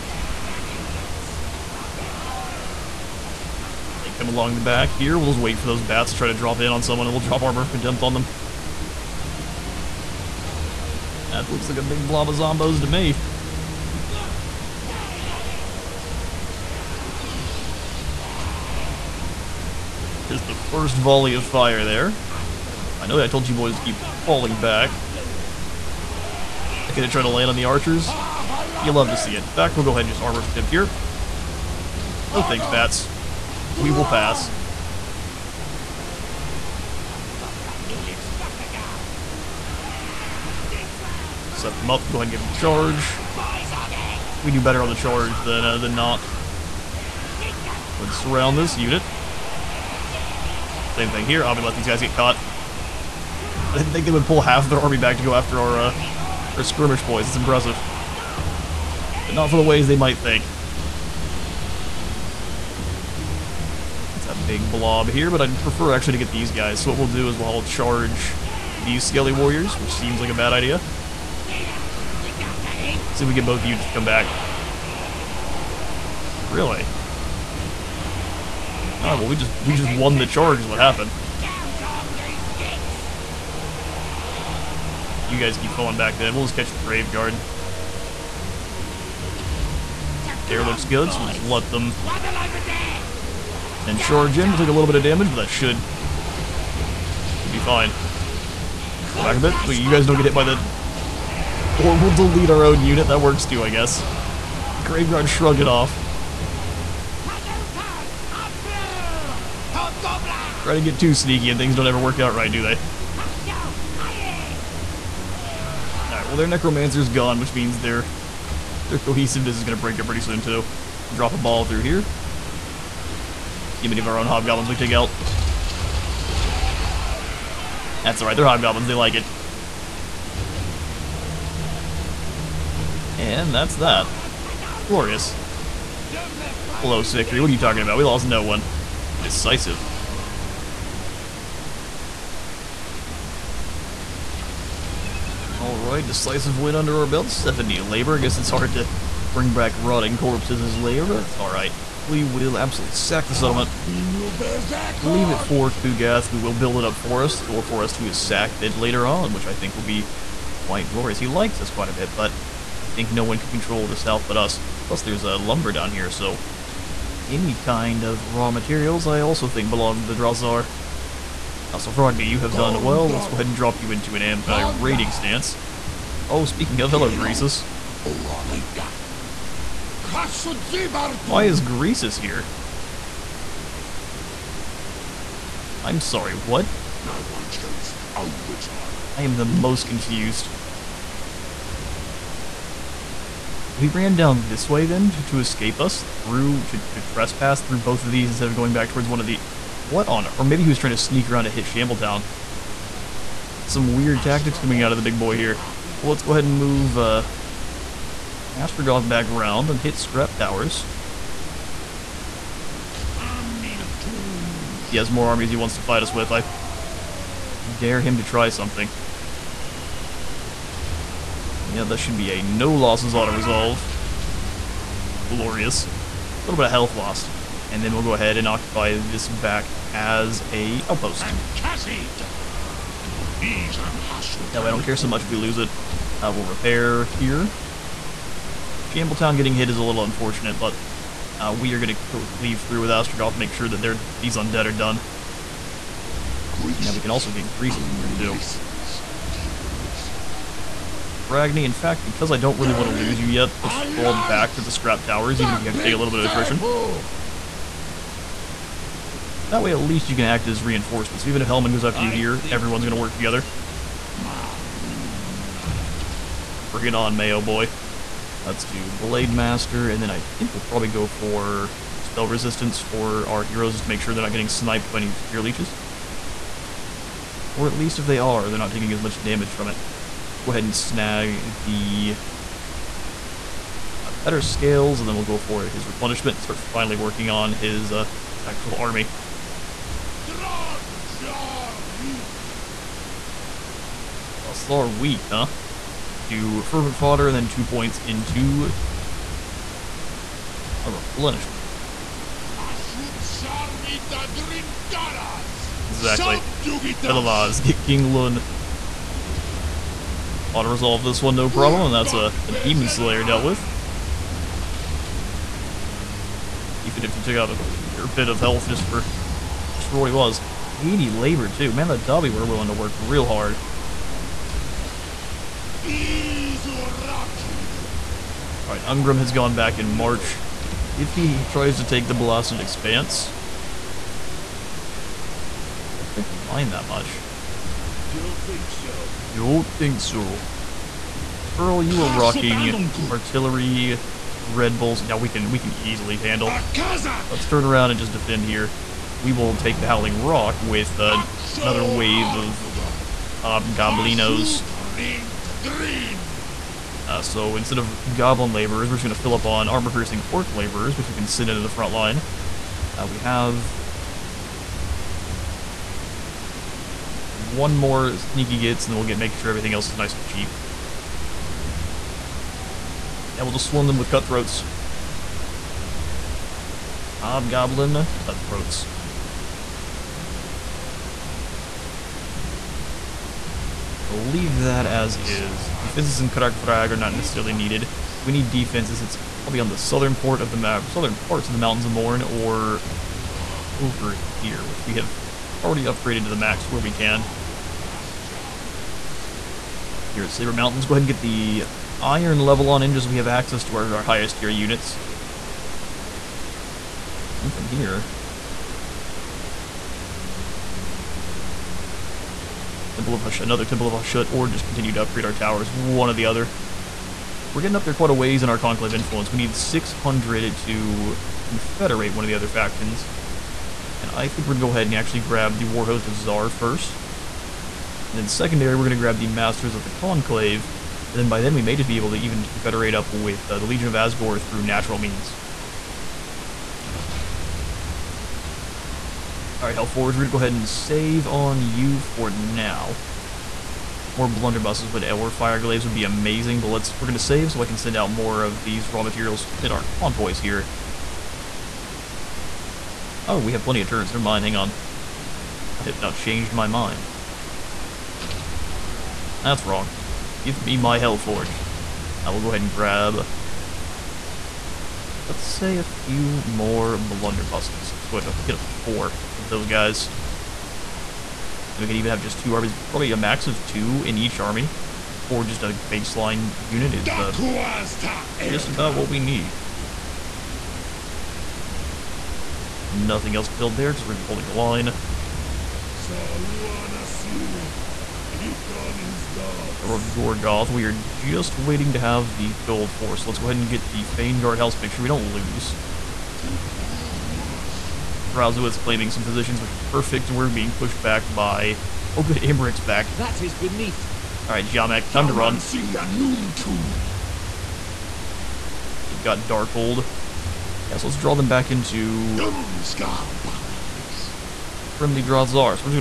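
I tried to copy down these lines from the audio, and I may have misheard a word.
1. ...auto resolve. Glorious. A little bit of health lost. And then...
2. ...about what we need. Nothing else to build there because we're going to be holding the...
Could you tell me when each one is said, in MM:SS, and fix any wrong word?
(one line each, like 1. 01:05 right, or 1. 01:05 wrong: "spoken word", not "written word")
1. 03:43 right
2. 07:58 right.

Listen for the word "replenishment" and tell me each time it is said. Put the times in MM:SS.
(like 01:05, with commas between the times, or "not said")
04:45, 05:00.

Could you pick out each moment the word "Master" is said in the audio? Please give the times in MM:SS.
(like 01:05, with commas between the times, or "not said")
04:29, 07:09.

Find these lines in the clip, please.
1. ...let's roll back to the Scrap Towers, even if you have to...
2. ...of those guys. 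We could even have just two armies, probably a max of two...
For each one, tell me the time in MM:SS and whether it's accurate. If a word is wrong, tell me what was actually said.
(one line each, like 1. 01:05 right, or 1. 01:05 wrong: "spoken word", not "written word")
1. 04:13 right
2. 07:49 right.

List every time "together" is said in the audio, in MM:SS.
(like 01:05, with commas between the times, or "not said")
04:23.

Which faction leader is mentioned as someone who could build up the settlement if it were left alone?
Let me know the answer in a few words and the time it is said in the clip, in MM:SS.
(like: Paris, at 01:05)
Kugath, at 02:35.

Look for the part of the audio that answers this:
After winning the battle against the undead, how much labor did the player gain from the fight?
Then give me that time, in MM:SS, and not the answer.
02:27.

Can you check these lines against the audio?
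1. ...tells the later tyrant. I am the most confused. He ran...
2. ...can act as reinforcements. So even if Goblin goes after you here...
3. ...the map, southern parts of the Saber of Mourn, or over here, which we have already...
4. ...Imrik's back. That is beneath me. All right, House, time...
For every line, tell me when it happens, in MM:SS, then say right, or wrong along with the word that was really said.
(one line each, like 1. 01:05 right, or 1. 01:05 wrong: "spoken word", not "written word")
1. 03:07 wrong: "older", not "later"
2. 04:20 wrong: "Helman", not "Goblin"
3. 06:30 wrong: "Mountains", not "Saber"
4. 08:22 wrong: "Jamek", not "House".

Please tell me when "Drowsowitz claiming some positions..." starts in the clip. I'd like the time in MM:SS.
08:18.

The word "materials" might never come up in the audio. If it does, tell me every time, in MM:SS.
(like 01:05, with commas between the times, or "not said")
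02:48, 07:29.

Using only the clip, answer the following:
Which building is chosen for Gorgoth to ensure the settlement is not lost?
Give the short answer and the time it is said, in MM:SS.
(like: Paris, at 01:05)
Fane Guard House, at 08:14.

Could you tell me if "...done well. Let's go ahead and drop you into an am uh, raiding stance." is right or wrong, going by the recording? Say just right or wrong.
right.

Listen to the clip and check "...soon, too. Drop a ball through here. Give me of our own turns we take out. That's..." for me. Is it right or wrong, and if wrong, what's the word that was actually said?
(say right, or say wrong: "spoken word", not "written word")
wrong: "hobgoblins", not "turns".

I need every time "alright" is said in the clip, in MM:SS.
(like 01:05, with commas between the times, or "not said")
02:08, 02:25, 02:31, 05:28, 07:19.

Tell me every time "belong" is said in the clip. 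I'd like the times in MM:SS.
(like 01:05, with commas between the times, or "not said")
02:49.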